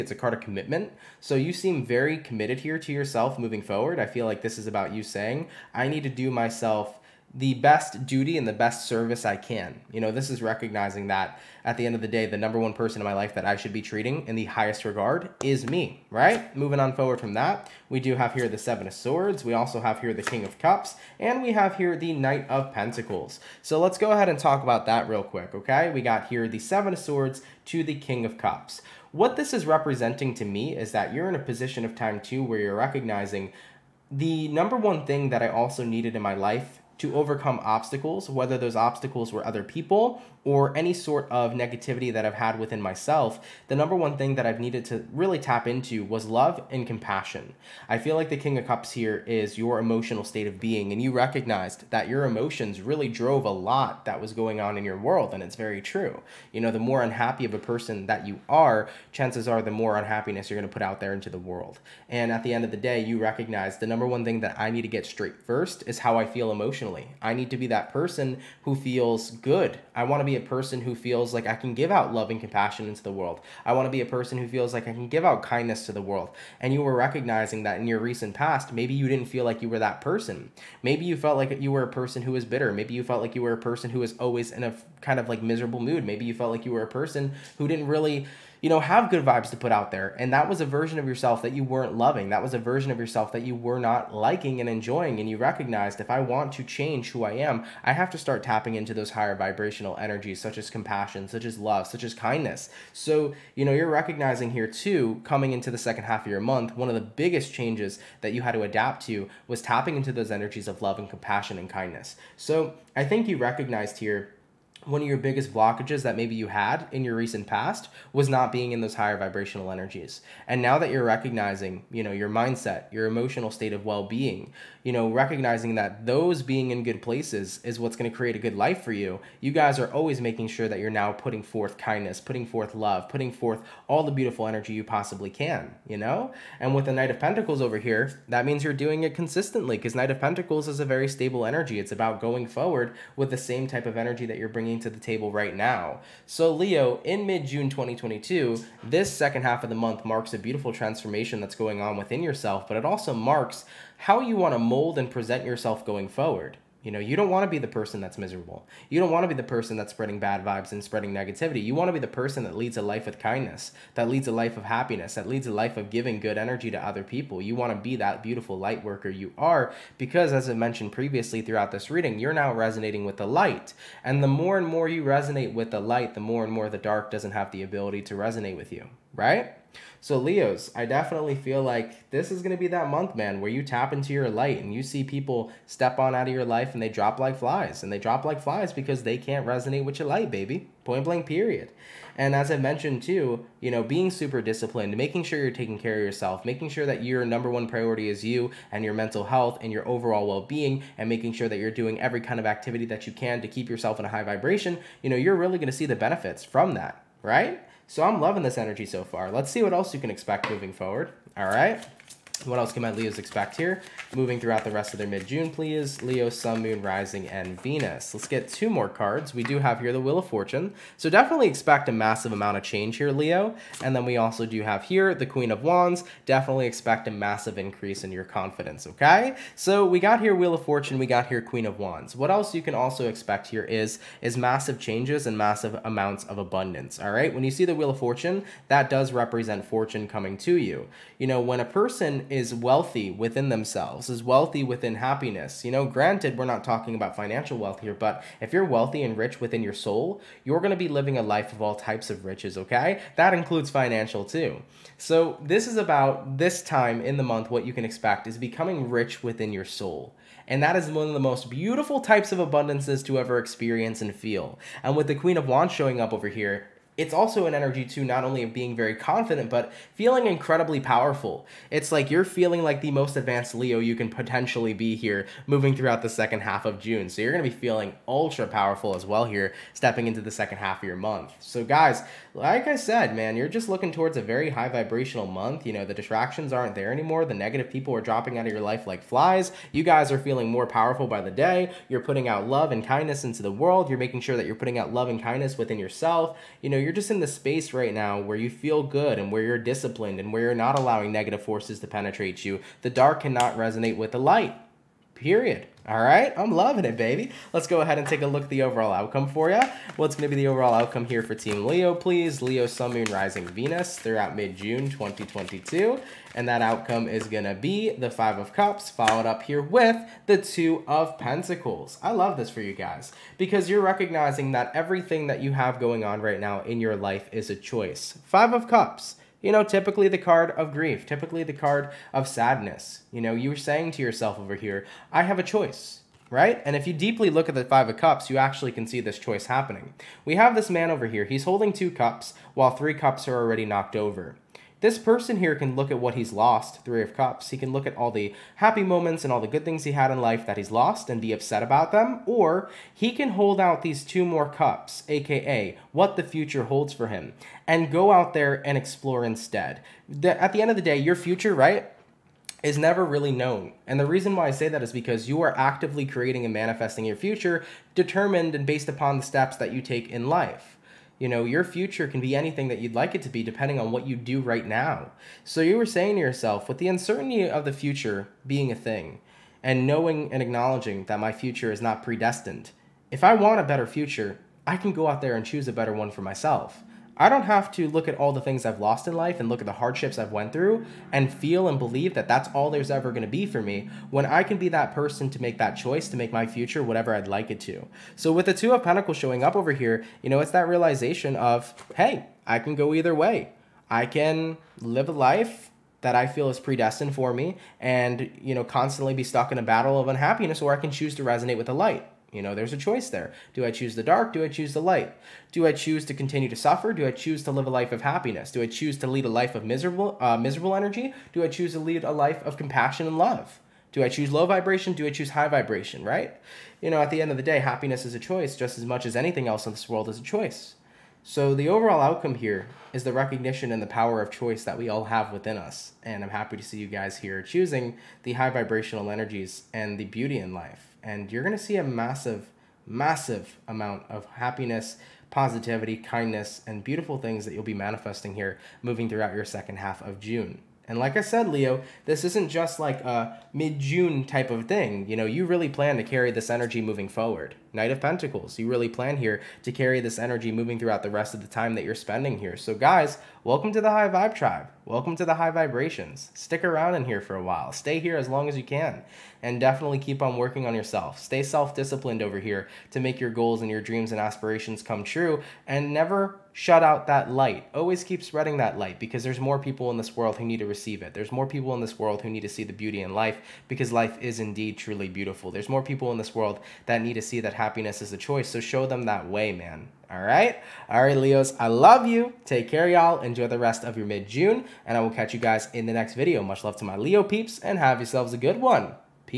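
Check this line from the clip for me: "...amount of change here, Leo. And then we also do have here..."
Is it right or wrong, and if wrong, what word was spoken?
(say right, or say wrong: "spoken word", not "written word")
right.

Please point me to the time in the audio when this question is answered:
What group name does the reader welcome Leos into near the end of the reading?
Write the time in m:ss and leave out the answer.
7:43.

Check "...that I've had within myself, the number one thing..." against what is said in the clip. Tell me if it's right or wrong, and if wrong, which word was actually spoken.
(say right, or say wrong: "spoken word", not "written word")
right.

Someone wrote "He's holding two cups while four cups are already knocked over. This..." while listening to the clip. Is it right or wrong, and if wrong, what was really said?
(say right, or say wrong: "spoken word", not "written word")
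wrong: "three", not "four".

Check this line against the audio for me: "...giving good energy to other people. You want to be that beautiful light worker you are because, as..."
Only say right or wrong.
right.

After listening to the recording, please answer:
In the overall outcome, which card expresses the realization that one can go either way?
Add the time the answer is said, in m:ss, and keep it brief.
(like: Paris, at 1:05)
Two of Pentacles, at 5:20.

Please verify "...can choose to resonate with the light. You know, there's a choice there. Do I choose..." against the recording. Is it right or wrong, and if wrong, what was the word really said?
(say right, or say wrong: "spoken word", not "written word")
right.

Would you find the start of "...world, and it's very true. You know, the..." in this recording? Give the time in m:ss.
0:54.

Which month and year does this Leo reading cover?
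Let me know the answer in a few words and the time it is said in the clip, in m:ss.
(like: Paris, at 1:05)
June 2022, at 2:27.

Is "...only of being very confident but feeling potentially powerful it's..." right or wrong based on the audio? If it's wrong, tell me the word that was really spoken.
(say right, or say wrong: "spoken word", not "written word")
wrong: "incredibly", not "potentially".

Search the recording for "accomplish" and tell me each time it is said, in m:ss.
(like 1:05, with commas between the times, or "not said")
not said.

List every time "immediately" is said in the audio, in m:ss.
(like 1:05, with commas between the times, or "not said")
not said.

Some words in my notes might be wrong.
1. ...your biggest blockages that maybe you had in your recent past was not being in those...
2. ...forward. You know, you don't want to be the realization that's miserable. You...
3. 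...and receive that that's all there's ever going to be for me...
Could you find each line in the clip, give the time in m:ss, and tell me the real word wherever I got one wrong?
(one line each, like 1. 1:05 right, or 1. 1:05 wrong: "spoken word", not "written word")
1. 1:55 right
2. 2:36 wrong: "person", not "realization"
3. 6:31 wrong: "believe", not "receive".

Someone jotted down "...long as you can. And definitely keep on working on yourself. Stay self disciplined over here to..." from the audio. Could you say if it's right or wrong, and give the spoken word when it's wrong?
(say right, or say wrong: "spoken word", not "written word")
right.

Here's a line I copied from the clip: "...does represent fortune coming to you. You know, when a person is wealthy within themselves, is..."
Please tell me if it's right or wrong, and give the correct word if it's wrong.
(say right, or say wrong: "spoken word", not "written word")
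right.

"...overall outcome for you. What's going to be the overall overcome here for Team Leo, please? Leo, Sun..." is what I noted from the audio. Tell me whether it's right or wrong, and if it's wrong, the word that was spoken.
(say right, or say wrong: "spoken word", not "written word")
wrong: "outcome", not "overcome".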